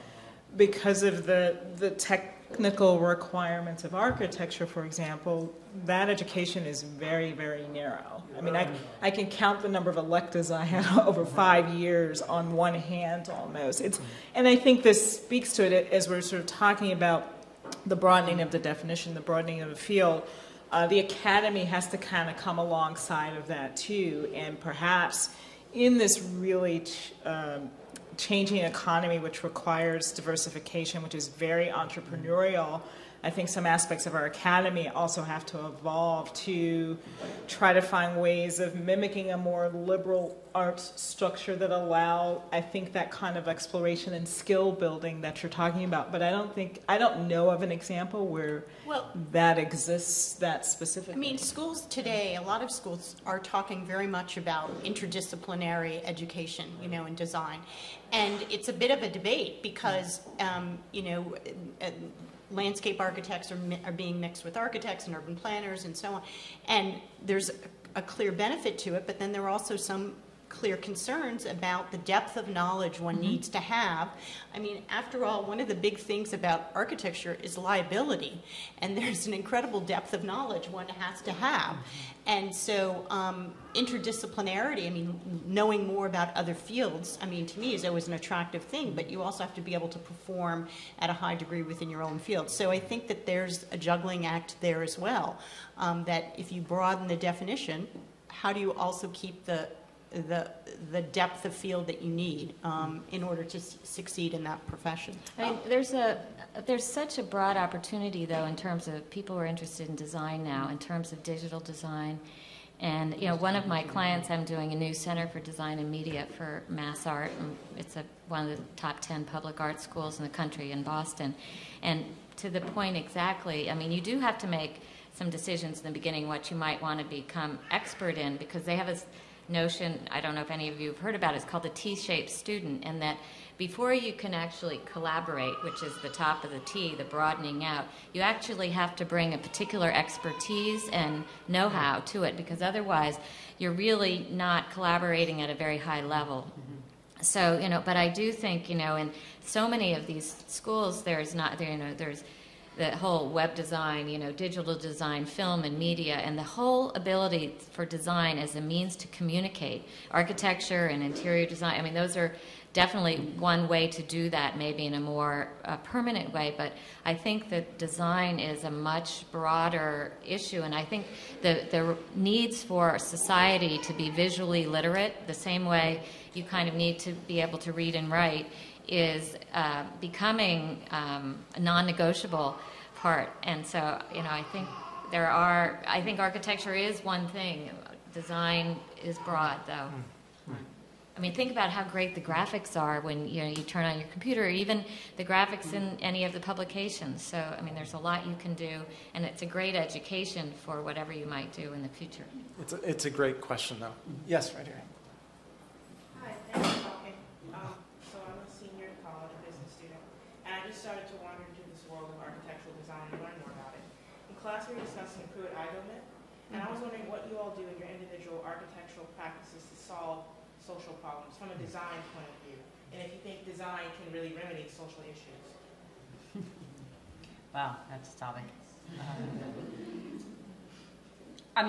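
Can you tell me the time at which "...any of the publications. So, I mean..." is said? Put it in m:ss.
3:16.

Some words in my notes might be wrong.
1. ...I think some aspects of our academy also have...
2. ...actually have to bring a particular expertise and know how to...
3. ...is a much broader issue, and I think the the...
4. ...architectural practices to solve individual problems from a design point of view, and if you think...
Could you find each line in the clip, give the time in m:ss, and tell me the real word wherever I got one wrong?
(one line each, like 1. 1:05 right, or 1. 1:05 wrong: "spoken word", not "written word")
1. 0:33 right
2. 2:18 right
3. 2:48 right
4. 3:38 wrong: "social", not "individual".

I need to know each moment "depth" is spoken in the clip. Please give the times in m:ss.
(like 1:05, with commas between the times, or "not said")
1:11, 1:19, 1:41.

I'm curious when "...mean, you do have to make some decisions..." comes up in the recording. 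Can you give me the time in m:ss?
2:03.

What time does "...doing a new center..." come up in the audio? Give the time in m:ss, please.
1:54.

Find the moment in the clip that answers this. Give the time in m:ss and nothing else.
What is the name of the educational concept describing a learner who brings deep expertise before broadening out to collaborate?
2:11.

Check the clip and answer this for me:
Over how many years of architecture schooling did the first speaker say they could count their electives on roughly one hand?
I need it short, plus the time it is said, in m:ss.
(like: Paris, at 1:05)
5, at 0:11.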